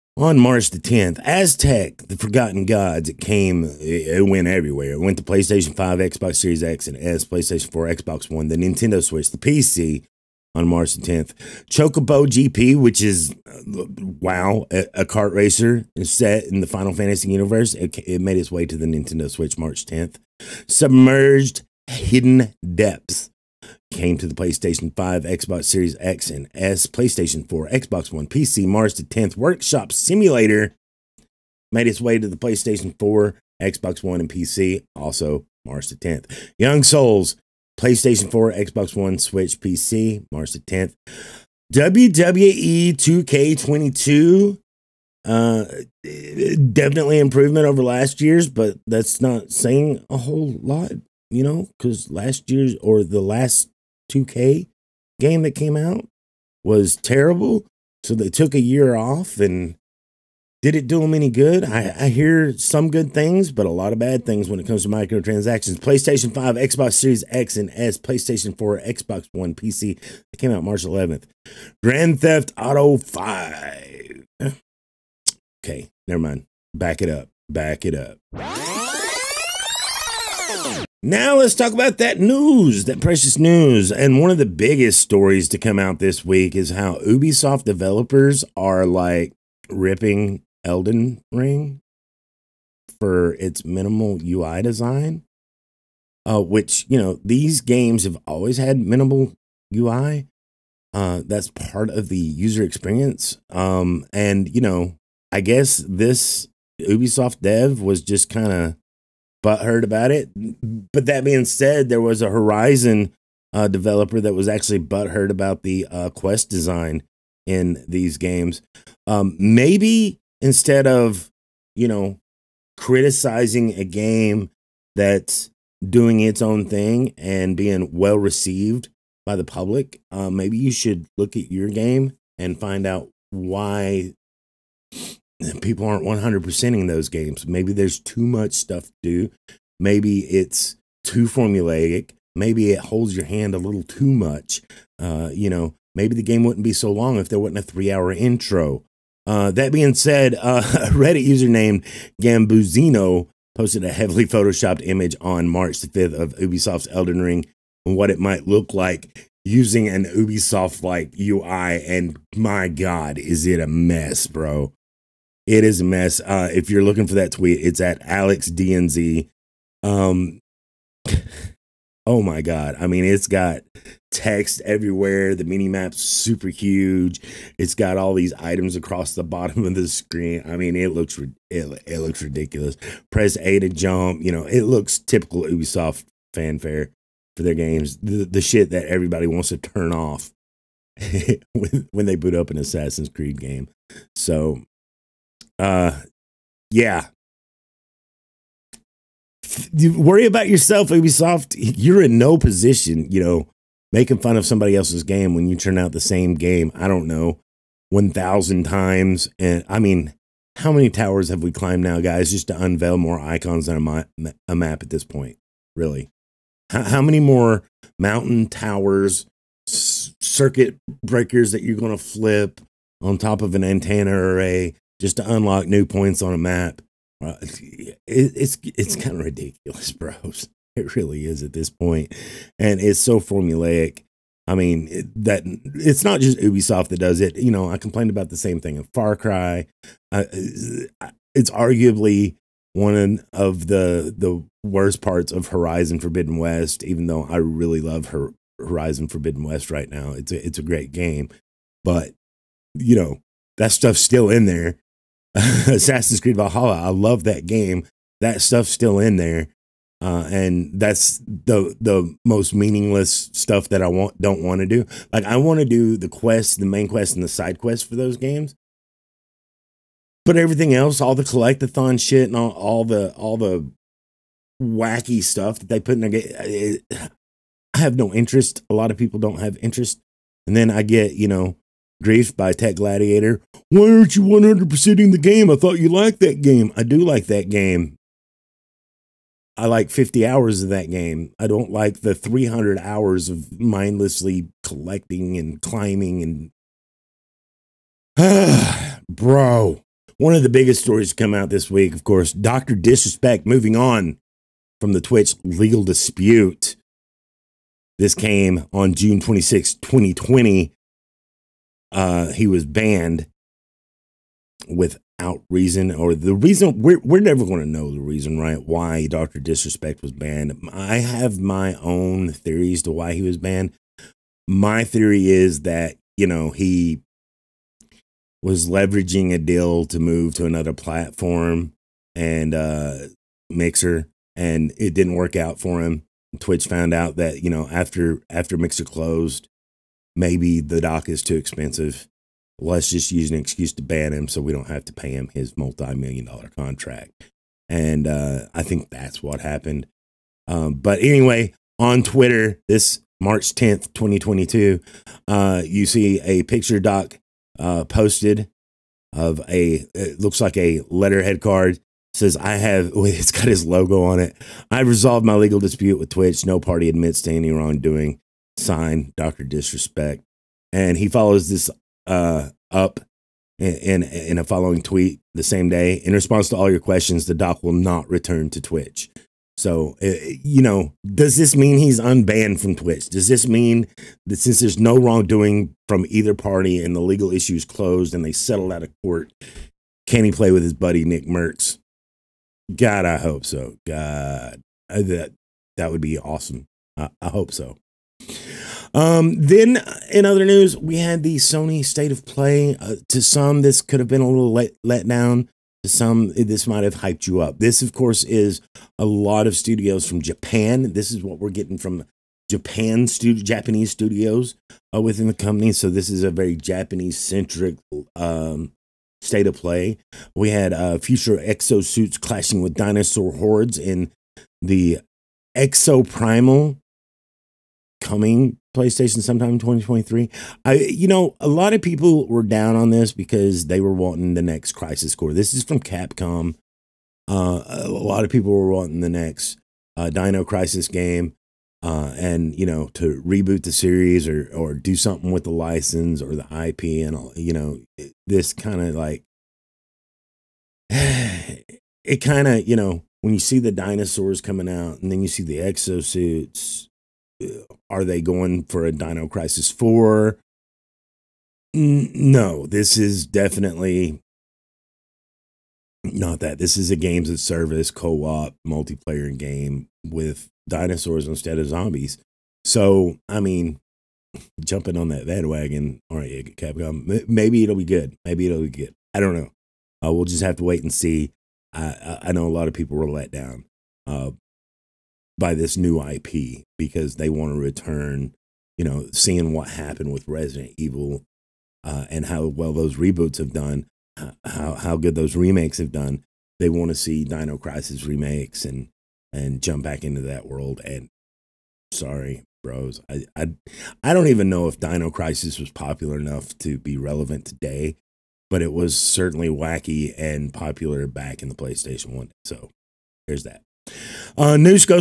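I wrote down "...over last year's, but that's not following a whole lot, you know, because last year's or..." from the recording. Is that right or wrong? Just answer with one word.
wrong.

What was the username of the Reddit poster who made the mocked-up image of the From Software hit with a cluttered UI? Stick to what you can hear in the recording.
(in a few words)
Gambuzino.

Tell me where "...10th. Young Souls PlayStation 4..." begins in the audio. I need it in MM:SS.
00:35.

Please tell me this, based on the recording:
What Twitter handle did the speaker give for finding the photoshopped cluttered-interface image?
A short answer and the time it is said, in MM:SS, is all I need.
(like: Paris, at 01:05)
AlexDNZ, at 02:48.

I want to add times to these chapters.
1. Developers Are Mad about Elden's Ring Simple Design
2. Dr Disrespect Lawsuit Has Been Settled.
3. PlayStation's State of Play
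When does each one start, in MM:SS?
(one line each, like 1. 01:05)
1. 01:21
2. 05:00
3. 06:38.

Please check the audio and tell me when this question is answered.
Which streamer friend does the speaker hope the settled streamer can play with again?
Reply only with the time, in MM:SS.
06:31.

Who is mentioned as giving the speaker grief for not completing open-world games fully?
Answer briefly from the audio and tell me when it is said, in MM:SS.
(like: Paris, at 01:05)
Tech Gladiator, at 04:42.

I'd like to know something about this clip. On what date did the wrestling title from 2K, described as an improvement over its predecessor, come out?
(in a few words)
March 11th.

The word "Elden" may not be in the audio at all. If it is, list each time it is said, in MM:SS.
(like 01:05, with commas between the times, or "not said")
01:30, 02:36.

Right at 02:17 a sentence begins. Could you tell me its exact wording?
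Maybe there's too much stuff to do.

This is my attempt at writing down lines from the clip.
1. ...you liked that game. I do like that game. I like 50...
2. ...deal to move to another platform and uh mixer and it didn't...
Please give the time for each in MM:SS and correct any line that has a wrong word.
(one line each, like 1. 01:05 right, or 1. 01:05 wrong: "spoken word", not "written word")
1. 04:45 right
2. 05:29 right.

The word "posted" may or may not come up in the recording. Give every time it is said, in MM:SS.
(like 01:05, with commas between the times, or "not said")
02:33, 05:57.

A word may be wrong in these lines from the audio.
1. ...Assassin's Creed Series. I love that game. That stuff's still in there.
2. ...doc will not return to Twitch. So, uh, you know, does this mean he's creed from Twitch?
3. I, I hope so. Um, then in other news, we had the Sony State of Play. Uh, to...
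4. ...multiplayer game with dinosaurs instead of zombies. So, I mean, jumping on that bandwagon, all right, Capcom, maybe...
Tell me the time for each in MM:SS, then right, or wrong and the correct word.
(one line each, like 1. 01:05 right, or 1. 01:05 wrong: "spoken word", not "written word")
1. 04:15 wrong: "Valhalla", not "Series"
2. 06:17 wrong: "unbanned", not "creed"
3. 06:36 right
4. 07:48 right.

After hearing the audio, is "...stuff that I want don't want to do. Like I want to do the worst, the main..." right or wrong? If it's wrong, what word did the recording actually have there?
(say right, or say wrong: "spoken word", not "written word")
wrong: "quest", not "worst".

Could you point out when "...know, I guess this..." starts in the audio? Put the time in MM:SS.
01:44.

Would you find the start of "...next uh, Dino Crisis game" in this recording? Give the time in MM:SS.
07:19.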